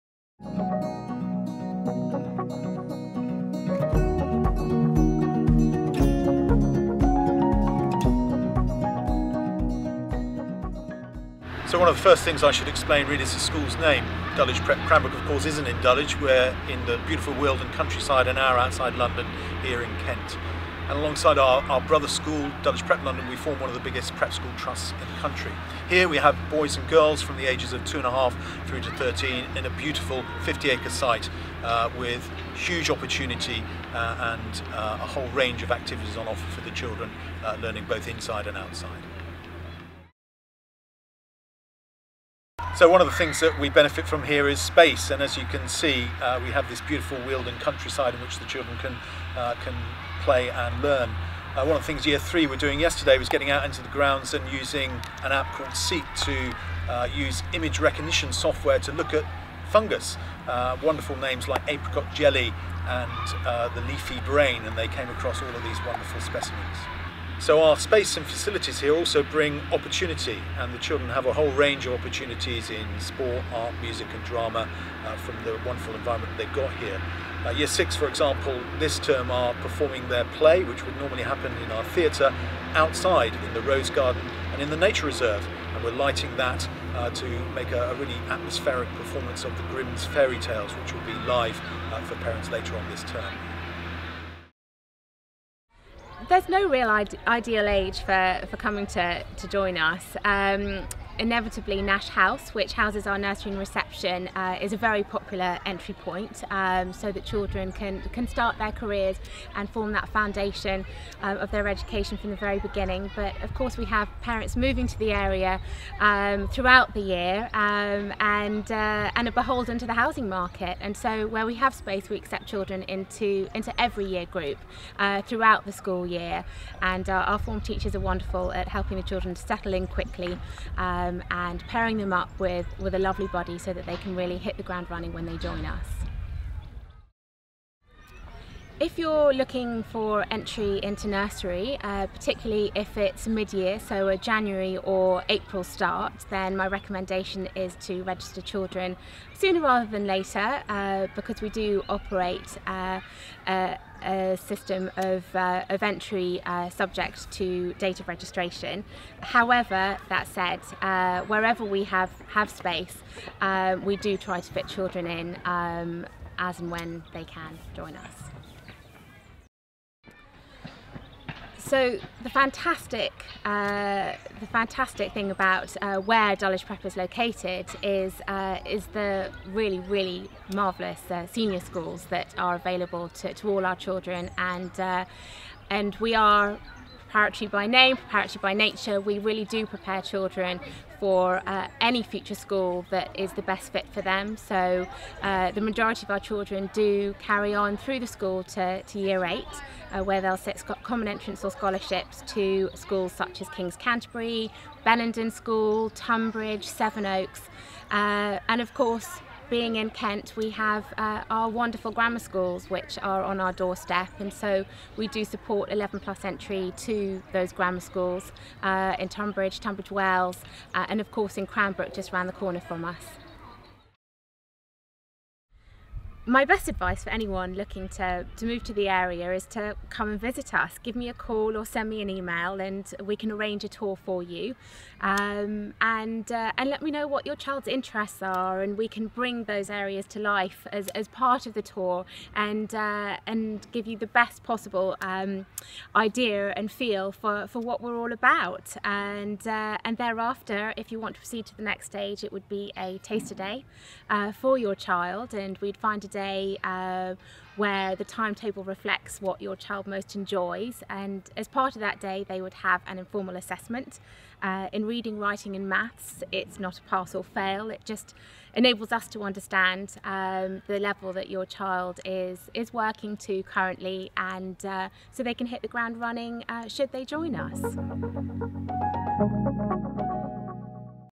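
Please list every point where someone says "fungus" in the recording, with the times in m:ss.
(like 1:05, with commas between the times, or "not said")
0:59.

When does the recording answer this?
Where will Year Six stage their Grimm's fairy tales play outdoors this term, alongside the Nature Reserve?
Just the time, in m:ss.
1:23.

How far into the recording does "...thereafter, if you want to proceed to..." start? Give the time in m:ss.
4:09.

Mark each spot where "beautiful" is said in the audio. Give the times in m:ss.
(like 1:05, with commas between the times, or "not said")
0:17, 0:29, 0:46.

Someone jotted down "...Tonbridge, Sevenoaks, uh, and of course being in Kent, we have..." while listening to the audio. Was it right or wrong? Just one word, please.
right.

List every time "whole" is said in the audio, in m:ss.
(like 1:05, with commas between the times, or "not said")
0:35, 1:11.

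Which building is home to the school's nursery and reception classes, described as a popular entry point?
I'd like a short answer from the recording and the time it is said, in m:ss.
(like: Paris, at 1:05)
Nash House, at 1:41.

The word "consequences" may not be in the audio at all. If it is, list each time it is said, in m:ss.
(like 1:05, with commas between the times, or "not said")
not said.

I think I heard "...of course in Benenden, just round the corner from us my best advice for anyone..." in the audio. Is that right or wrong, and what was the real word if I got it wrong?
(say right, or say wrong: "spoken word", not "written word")
wrong: "Cranbrook", not "Benenden".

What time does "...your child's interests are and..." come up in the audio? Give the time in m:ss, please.
3:57.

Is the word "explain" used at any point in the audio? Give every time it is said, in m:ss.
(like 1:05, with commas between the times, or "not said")
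0:12.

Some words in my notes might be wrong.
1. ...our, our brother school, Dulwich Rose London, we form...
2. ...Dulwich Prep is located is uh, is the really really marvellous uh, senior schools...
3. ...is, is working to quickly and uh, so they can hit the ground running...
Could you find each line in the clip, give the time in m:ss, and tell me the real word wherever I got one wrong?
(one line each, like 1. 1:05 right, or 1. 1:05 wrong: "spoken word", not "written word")
1. 0:21 wrong: "Prep", not "Rose"
2. 2:56 right
3. 4:32 wrong: "currently", not "quickly".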